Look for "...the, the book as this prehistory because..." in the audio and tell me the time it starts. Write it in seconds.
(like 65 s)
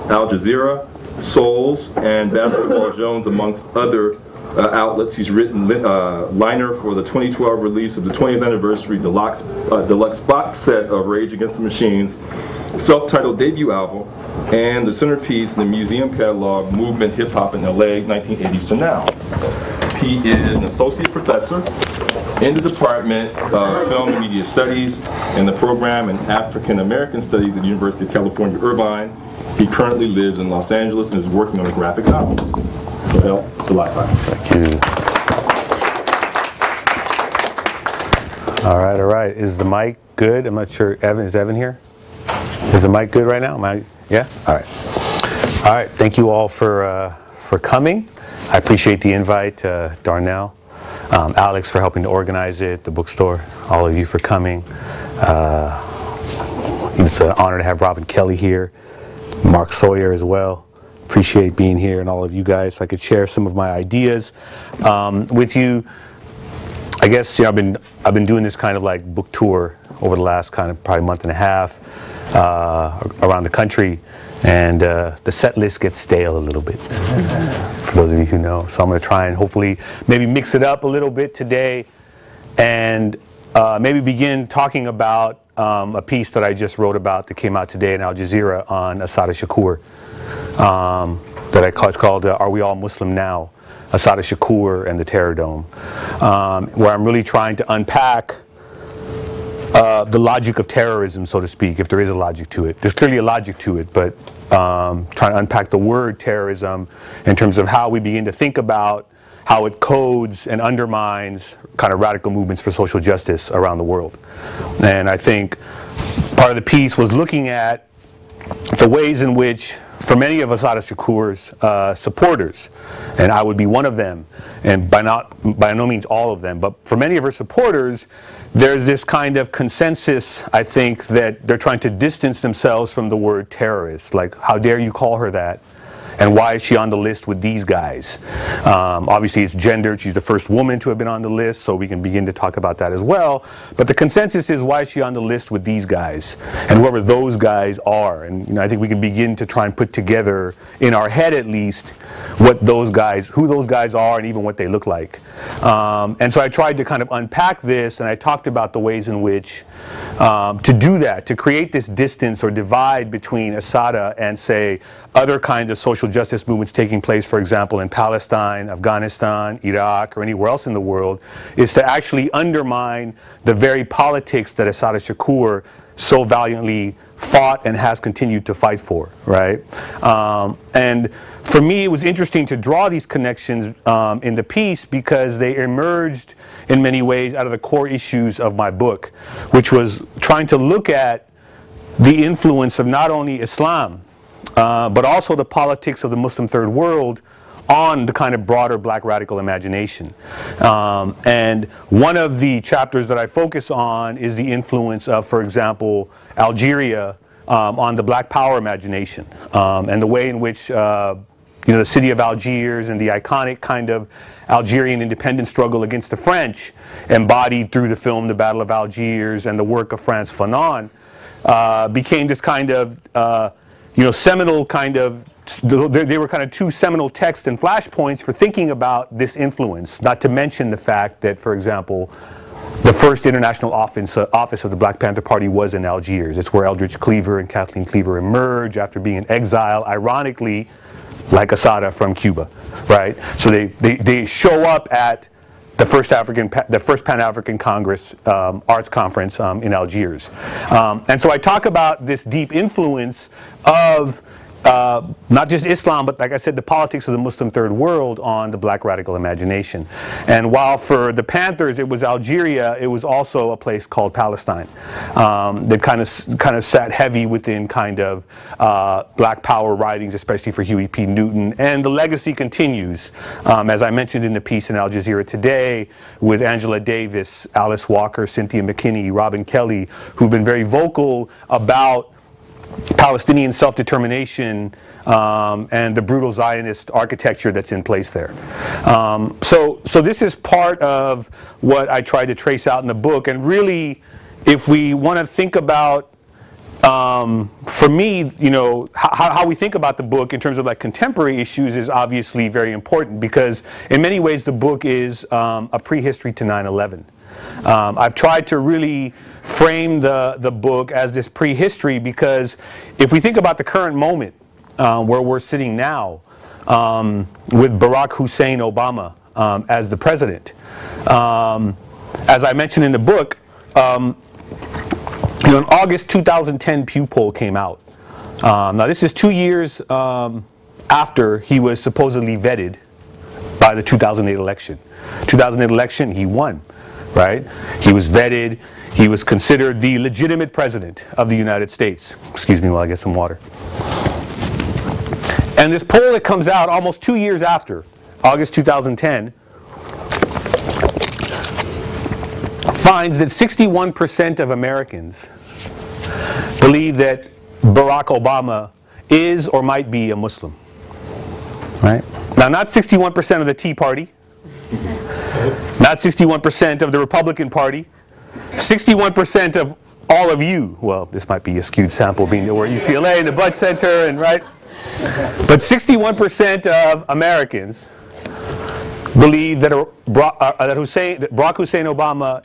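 310 s.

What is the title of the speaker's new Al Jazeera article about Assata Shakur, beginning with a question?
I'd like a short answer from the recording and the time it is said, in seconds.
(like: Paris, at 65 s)
Are We All Muslim Now?, at 92 s.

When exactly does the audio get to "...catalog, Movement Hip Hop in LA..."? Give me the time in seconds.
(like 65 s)
16 s.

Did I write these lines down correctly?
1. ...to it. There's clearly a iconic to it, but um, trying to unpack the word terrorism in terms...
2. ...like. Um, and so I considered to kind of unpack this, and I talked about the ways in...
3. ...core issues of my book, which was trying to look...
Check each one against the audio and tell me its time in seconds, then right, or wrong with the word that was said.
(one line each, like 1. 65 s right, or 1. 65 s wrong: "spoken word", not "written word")
1. 102 s wrong: "logic", not "iconic"
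2. 154 s wrong: "tried", not "considered"
3. 187 s right.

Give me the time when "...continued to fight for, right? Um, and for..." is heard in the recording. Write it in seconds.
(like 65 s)
177 s.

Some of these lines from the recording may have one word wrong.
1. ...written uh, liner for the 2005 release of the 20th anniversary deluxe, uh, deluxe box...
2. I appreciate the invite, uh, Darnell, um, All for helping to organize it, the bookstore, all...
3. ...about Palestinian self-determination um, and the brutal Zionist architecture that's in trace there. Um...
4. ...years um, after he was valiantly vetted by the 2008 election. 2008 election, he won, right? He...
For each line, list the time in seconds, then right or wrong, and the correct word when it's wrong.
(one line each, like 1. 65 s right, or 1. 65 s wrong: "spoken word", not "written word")
1. 5 s wrong: "2012", not "2005"
2. 48 s wrong: "Alex", not "All"
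3. 281 s wrong: "place", not "trace"
4. 329 s wrong: "supposedly", not "valiantly".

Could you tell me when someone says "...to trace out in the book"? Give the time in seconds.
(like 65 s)
292 s.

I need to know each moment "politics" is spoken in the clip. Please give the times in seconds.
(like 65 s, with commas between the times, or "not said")
173 s, 195 s, 256 s.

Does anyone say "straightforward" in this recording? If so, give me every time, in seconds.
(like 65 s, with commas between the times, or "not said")
not said.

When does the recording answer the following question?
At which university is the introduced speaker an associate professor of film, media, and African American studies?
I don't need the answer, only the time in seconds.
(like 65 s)
27 s.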